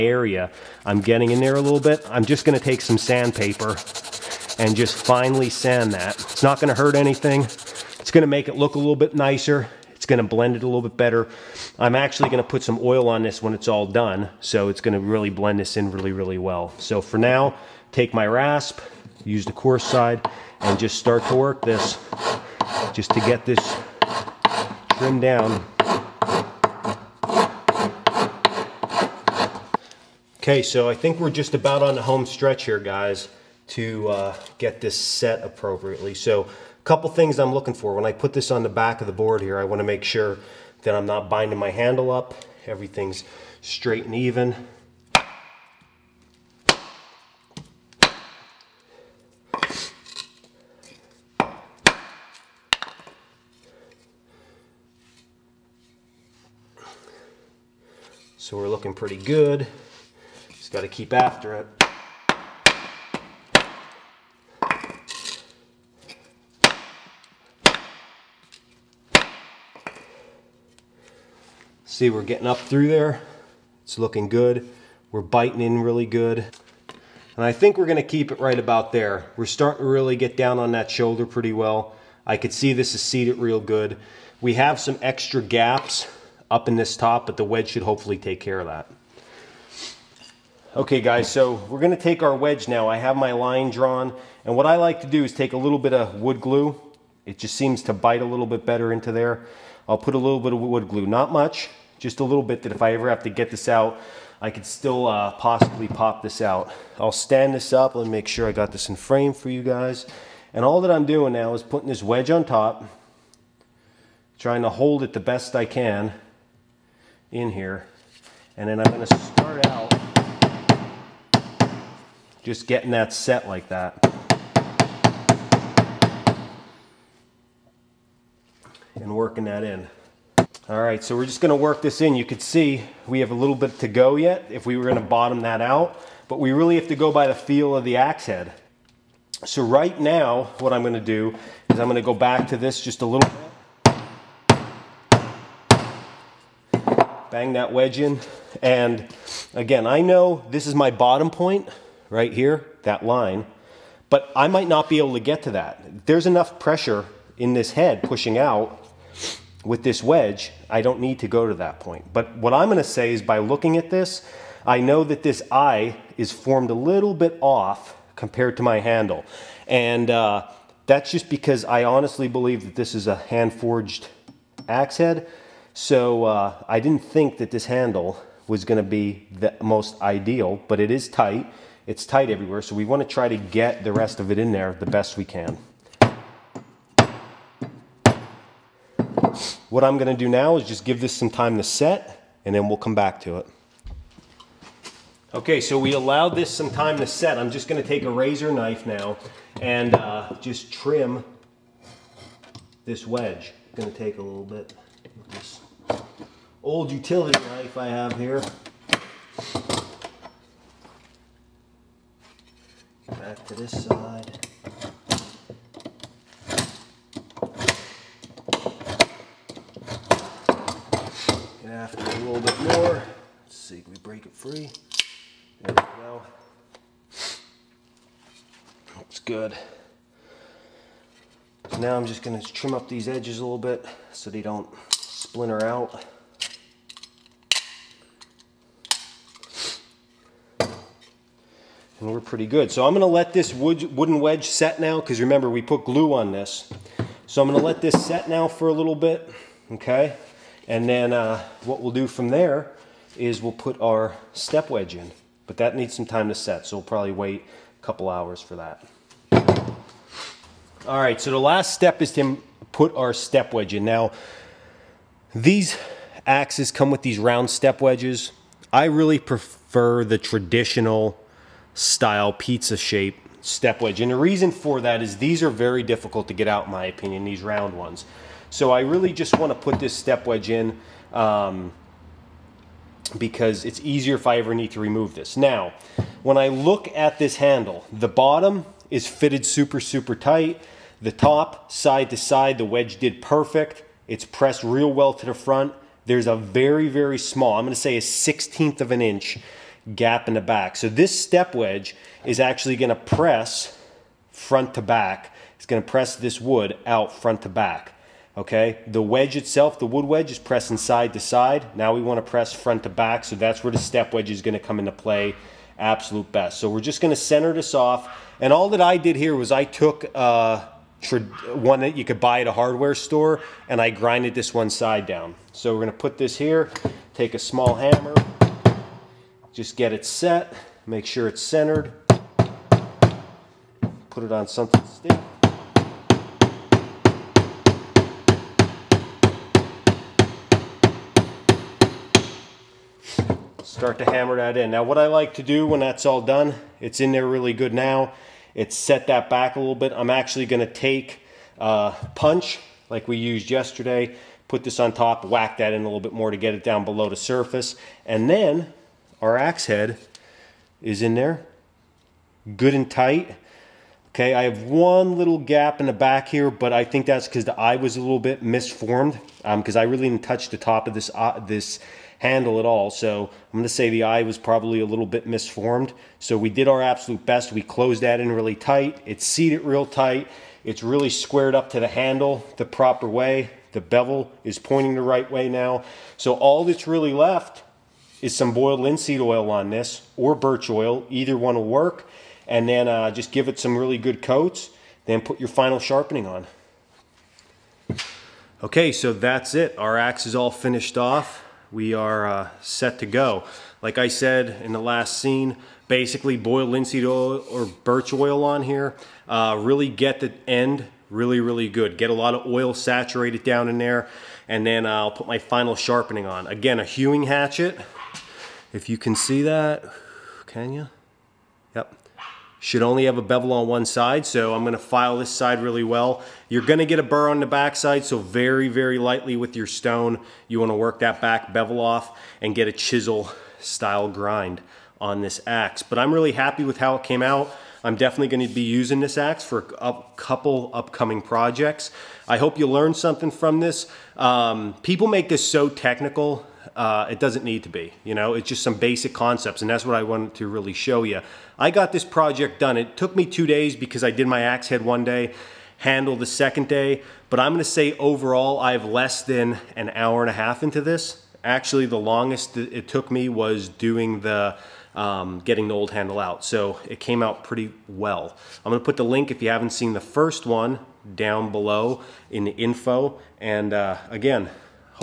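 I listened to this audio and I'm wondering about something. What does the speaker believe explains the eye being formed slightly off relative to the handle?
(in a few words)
hand-forged axe head.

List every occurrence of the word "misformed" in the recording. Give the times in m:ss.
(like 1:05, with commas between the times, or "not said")
6:08, 6:15.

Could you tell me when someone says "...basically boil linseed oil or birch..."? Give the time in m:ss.
6:45.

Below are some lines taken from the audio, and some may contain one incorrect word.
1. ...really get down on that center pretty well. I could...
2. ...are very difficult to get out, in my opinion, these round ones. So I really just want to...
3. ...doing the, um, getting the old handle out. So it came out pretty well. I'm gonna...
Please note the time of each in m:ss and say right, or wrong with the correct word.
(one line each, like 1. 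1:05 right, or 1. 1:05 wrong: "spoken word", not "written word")
1. 1:19 wrong: "shoulder", not "center"
2. 4:35 right
3. 7:43 right.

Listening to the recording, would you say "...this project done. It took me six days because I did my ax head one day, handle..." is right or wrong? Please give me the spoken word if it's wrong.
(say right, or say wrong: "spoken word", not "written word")
wrong: "two", not "six".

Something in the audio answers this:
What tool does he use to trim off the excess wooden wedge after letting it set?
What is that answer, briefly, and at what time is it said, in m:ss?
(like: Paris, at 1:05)
razor knife, at 3:18.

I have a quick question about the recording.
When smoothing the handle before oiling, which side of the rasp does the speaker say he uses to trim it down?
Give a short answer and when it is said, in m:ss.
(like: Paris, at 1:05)
coarse side, at 0:19.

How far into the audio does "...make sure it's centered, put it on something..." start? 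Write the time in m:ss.
5:30.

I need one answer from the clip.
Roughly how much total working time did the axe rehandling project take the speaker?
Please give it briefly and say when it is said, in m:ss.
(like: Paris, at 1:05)
less than an hour and a half, at 7:38.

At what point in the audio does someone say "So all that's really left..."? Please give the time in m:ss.
6:26.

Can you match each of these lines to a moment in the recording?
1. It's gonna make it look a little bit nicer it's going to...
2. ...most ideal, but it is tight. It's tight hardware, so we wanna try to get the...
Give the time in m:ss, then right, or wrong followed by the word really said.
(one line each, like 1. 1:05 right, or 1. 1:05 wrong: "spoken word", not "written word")
1. 0:07 right
2. 2:59 wrong: "everywhere", not "hardware".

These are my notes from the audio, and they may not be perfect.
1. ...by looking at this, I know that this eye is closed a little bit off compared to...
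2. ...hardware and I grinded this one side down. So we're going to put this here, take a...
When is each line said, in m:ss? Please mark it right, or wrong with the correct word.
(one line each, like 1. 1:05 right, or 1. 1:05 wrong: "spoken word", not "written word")
1. 2:43 wrong: "formed", not "closed"
2. 5:22 wrong: "store", not "hardware".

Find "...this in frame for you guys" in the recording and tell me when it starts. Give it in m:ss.
1:48.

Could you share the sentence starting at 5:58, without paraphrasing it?
And then our ax head is in there, good and tight.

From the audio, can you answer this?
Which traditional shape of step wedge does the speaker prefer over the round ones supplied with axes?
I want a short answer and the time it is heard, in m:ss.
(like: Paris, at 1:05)
pizza shape, at 4:32.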